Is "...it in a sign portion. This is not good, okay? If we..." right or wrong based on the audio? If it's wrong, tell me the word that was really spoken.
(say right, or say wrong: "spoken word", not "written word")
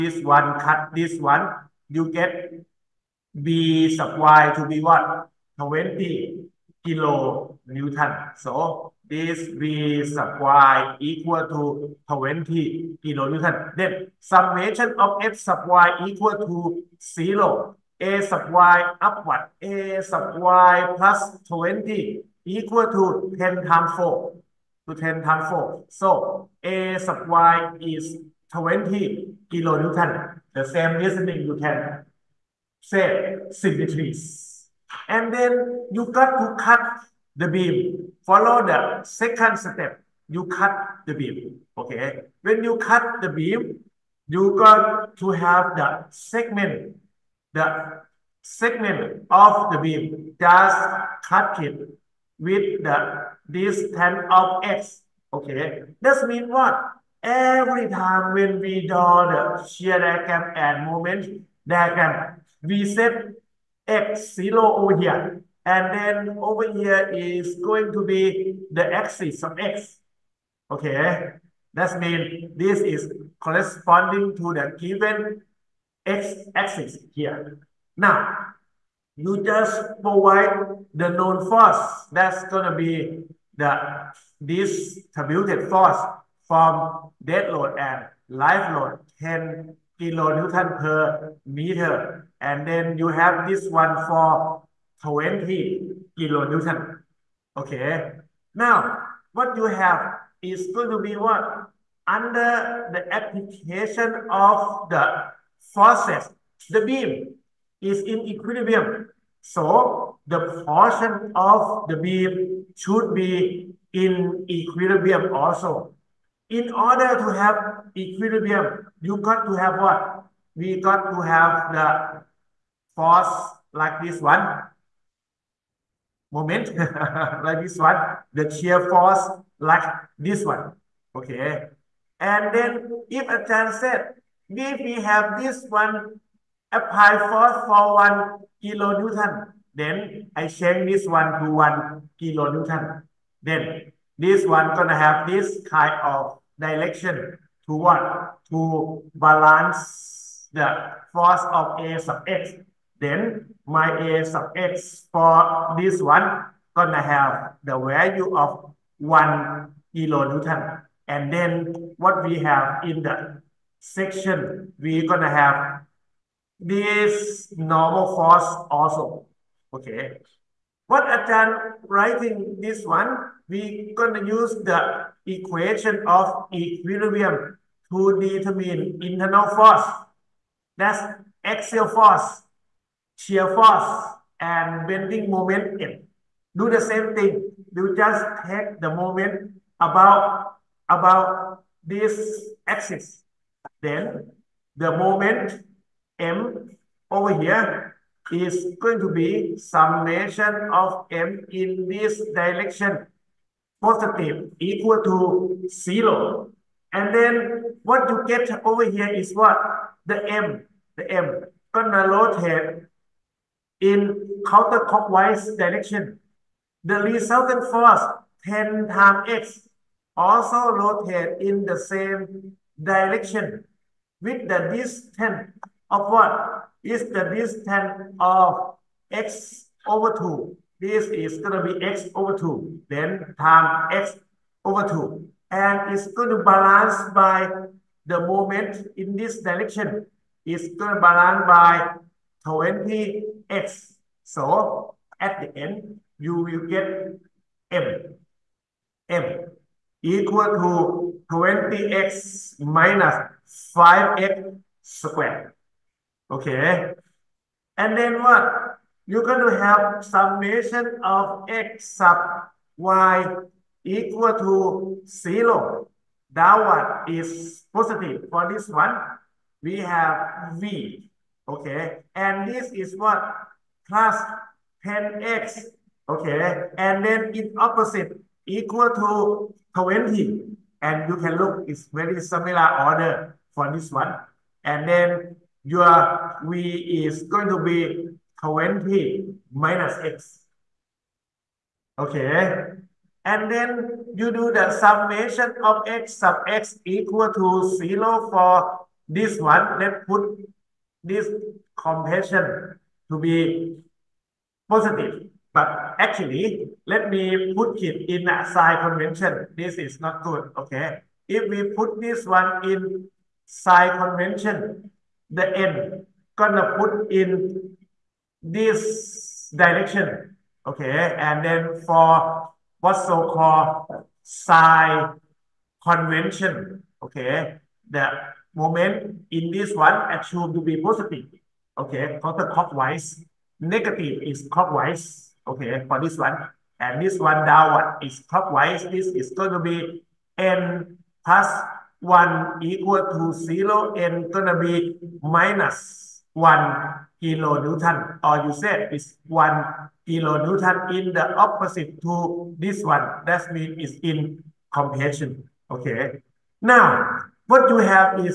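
wrong: "convention", not "portion".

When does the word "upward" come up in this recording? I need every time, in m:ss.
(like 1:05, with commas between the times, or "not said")
0:19.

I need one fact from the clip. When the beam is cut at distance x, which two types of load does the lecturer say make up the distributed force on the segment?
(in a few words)
dead load and live load.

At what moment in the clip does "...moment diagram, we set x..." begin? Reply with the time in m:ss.
1:00.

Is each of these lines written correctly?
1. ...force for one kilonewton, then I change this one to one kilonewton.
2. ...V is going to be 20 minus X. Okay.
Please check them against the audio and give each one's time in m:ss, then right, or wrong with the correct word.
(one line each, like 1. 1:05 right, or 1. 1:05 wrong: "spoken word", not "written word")
1. 2:17 right
2. 4:46 right.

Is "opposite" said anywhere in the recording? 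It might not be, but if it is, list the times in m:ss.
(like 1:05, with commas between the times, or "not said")
4:37, 5:51.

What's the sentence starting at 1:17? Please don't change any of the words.
Now, you just provide the known force.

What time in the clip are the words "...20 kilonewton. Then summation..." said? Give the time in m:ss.
0:12.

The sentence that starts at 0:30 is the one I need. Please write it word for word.
The same reasoning you can say symmetries.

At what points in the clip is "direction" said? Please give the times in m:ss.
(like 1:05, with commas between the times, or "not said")
2:26, 3:22, 3:35, 3:42, 3:59, 5:19.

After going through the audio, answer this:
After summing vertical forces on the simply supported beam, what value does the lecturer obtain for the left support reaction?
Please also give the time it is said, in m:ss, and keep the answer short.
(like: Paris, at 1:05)
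20 kilonewton, at 0:26.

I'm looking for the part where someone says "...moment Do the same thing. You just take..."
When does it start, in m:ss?
3:05.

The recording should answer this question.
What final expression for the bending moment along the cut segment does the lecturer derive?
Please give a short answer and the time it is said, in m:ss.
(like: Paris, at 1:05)
20x minus 5x squared, at 4:11.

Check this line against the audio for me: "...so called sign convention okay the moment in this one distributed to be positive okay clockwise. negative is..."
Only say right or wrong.
wrong.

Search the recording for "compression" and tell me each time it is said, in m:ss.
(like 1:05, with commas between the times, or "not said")
5:01, 5:54.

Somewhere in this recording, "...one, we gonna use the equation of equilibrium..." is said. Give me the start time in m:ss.
2:52.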